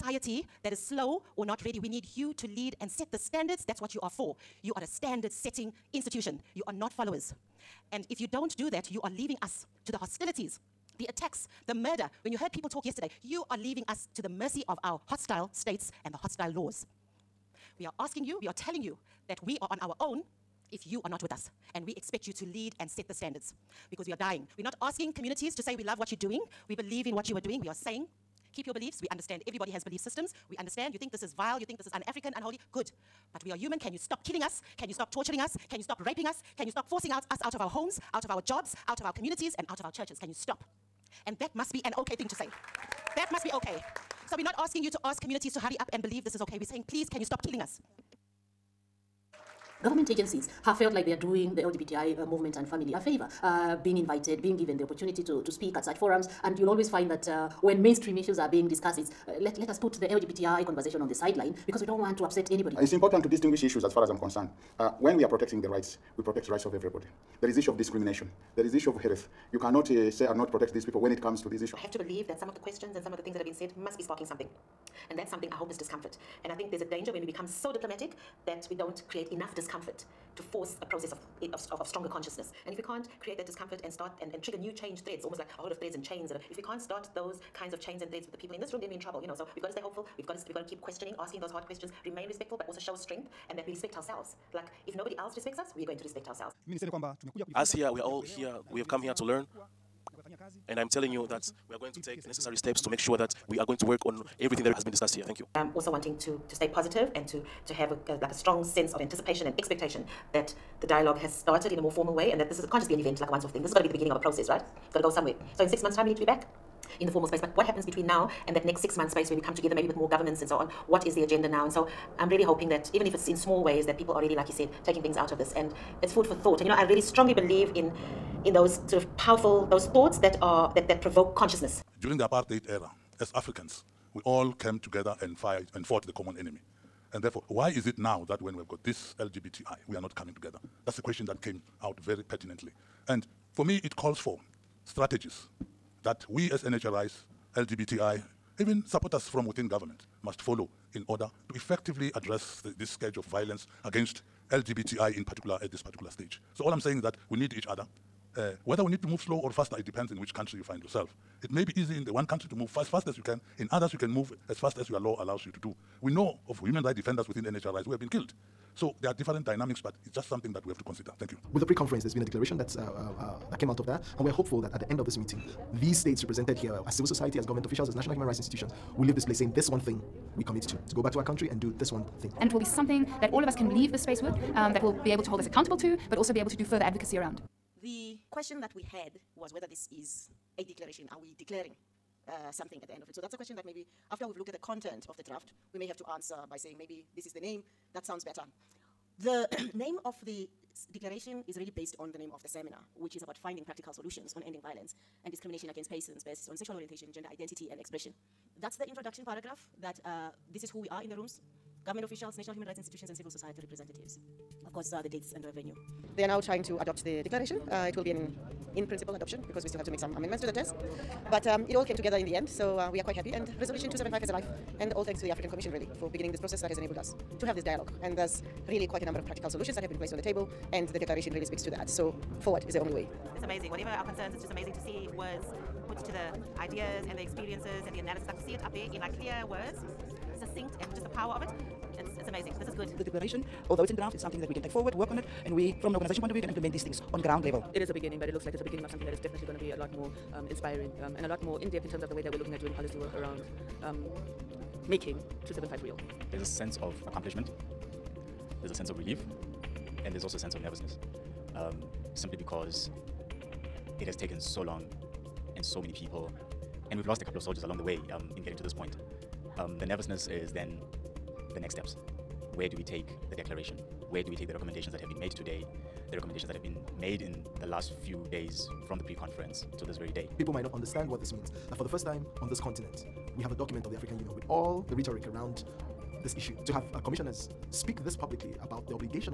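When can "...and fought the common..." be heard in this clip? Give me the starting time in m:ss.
2:15.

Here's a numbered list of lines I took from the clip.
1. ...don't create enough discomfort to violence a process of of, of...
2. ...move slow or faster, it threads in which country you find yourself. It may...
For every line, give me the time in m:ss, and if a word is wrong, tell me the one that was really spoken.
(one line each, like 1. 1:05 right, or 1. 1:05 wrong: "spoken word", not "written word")
1. 1:18 wrong: "force", not "violence"
2. 2:39 wrong: "depends", not "threads".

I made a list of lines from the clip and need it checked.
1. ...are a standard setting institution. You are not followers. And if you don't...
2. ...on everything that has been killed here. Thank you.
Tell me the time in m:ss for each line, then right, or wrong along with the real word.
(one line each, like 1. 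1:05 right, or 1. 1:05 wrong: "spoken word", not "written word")
1. 0:04 right
2. 1:44 wrong: "discussed", not "killed".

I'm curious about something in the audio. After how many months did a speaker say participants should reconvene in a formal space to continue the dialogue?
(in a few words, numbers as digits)
6.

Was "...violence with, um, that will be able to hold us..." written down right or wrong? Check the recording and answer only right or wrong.
wrong.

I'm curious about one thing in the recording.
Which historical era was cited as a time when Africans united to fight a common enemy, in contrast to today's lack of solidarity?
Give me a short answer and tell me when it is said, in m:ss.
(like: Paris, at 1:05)
apartheid era, at 2:12.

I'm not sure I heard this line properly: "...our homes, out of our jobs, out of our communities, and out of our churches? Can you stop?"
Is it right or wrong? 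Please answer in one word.
right.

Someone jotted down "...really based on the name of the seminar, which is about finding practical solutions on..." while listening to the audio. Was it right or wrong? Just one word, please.
right.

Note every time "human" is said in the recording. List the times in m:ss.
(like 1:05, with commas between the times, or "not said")
0:33, 2:46, 2:58, 3:32.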